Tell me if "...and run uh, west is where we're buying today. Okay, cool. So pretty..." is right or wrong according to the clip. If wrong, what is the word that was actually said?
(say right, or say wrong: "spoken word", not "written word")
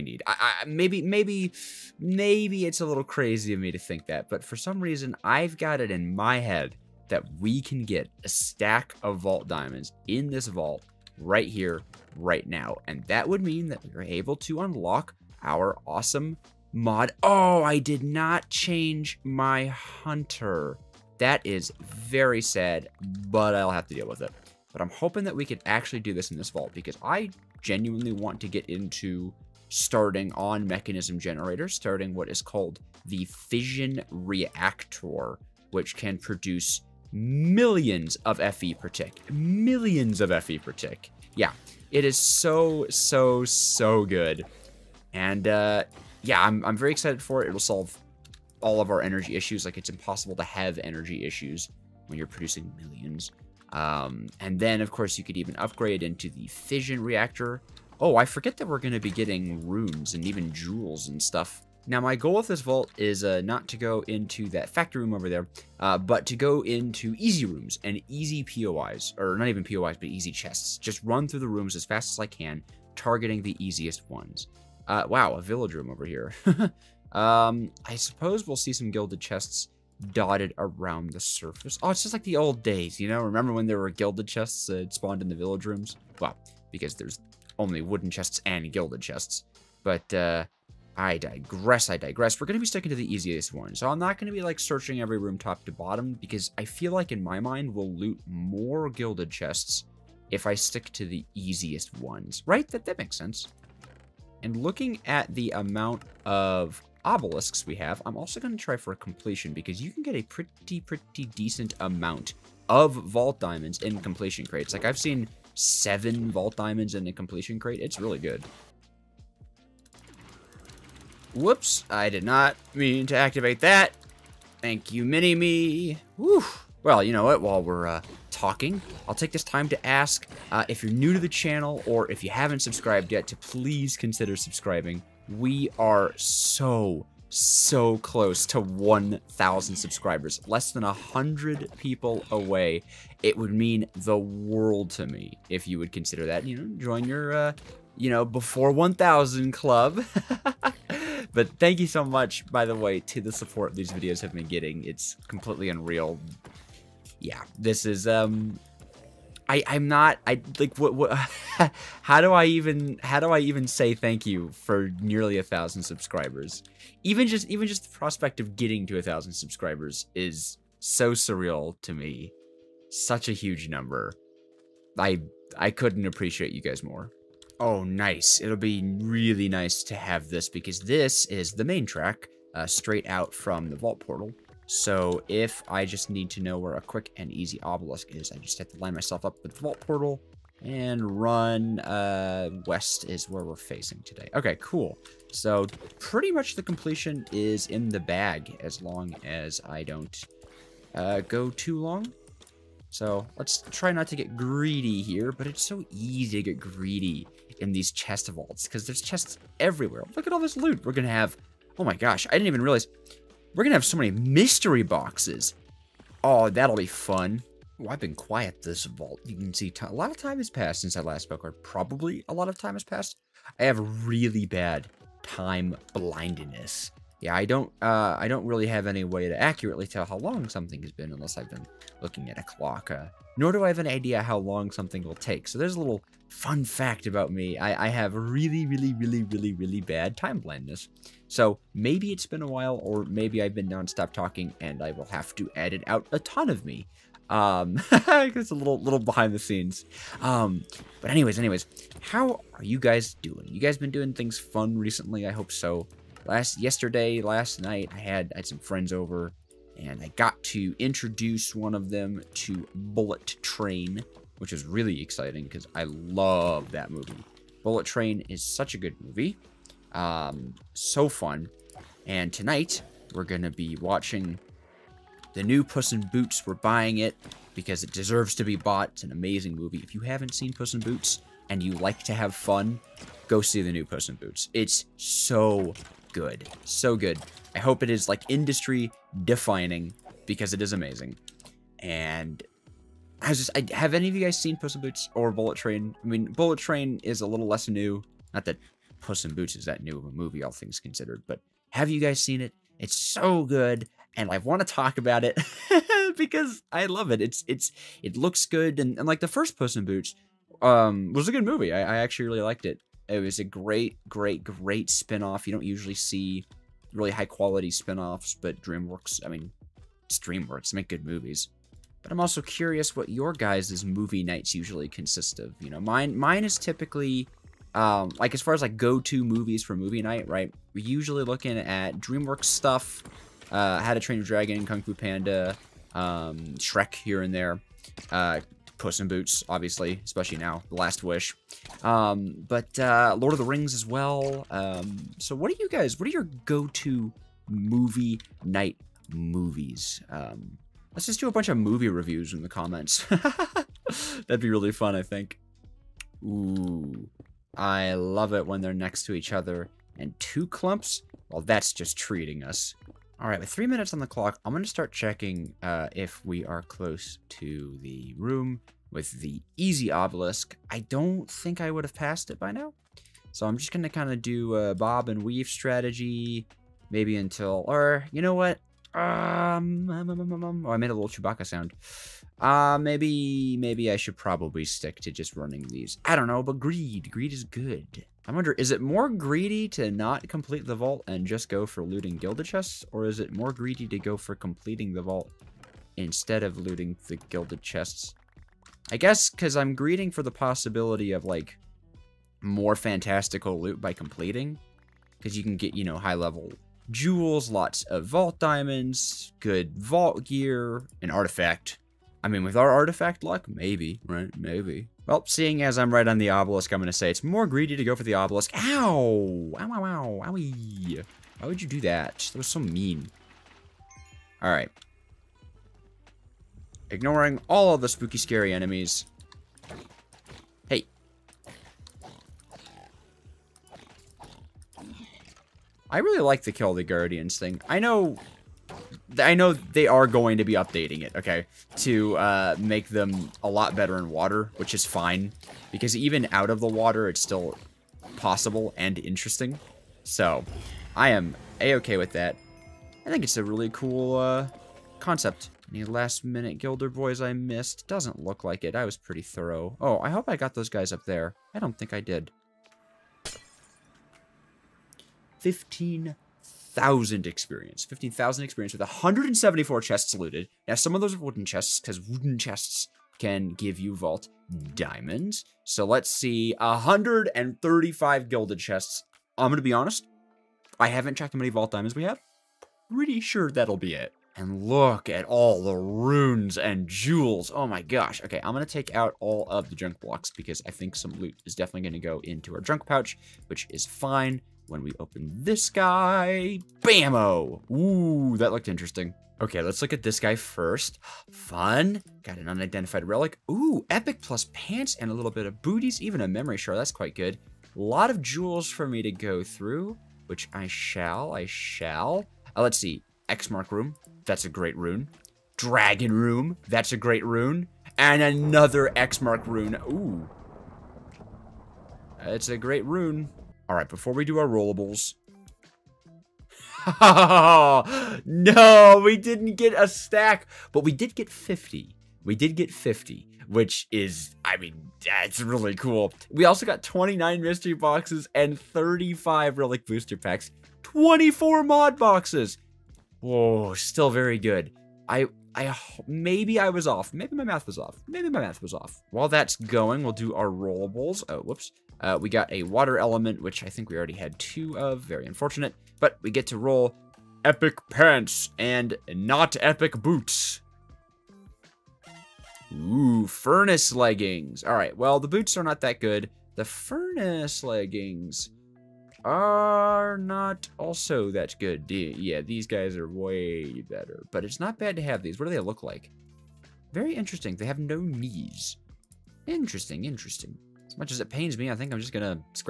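wrong: "facing", not "buying".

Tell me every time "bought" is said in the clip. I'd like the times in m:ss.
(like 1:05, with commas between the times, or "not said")
4:38.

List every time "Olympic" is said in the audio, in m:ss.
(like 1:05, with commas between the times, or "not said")
not said.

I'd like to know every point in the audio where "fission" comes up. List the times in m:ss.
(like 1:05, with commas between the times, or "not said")
0:33, 0:56.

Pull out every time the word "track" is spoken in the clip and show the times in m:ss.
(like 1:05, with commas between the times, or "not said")
3:01.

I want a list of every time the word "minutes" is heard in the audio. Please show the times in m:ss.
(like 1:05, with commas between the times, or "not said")
6:03, 7:35.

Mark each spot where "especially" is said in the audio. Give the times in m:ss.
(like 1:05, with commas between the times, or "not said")
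5:40.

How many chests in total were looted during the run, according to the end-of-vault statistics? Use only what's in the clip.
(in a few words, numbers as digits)
174.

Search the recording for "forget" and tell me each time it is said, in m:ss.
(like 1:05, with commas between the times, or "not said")
0:58.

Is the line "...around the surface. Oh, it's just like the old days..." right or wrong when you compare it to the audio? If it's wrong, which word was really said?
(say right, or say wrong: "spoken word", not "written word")
right.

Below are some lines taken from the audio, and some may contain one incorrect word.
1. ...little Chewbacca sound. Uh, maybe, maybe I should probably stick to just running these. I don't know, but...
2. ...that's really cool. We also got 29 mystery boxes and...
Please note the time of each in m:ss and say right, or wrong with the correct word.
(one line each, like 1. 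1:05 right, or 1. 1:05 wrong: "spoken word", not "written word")
1. 6:20 right
2. 8:55 right.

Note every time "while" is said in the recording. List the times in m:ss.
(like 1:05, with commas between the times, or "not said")
2:07, 4:02, 9:09.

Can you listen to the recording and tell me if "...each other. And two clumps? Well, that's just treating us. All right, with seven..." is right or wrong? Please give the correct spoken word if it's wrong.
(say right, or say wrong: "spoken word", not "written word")
wrong: "three", not "seven".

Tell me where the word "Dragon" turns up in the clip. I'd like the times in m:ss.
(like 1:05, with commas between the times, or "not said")
5:34, 8:35.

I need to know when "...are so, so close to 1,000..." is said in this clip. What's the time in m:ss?
2:15.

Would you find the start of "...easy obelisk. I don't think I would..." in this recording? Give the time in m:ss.
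6:09.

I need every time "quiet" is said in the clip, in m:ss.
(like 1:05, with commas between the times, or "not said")
3:38.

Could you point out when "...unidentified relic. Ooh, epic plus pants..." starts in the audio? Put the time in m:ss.
8:22.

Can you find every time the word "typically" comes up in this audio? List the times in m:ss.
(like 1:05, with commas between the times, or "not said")
5:26.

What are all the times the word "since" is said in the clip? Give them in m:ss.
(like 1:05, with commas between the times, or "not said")
3:40.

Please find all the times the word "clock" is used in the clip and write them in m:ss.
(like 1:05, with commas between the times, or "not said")
3:52, 6:04.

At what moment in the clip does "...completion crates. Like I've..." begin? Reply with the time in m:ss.
1:54.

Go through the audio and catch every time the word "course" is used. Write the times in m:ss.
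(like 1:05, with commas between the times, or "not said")
0:54.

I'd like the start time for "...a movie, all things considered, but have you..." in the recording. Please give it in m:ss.
5:00.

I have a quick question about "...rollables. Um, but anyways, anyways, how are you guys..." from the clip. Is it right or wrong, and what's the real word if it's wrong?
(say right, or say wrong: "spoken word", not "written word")
wrong: "scenes", not "rollables".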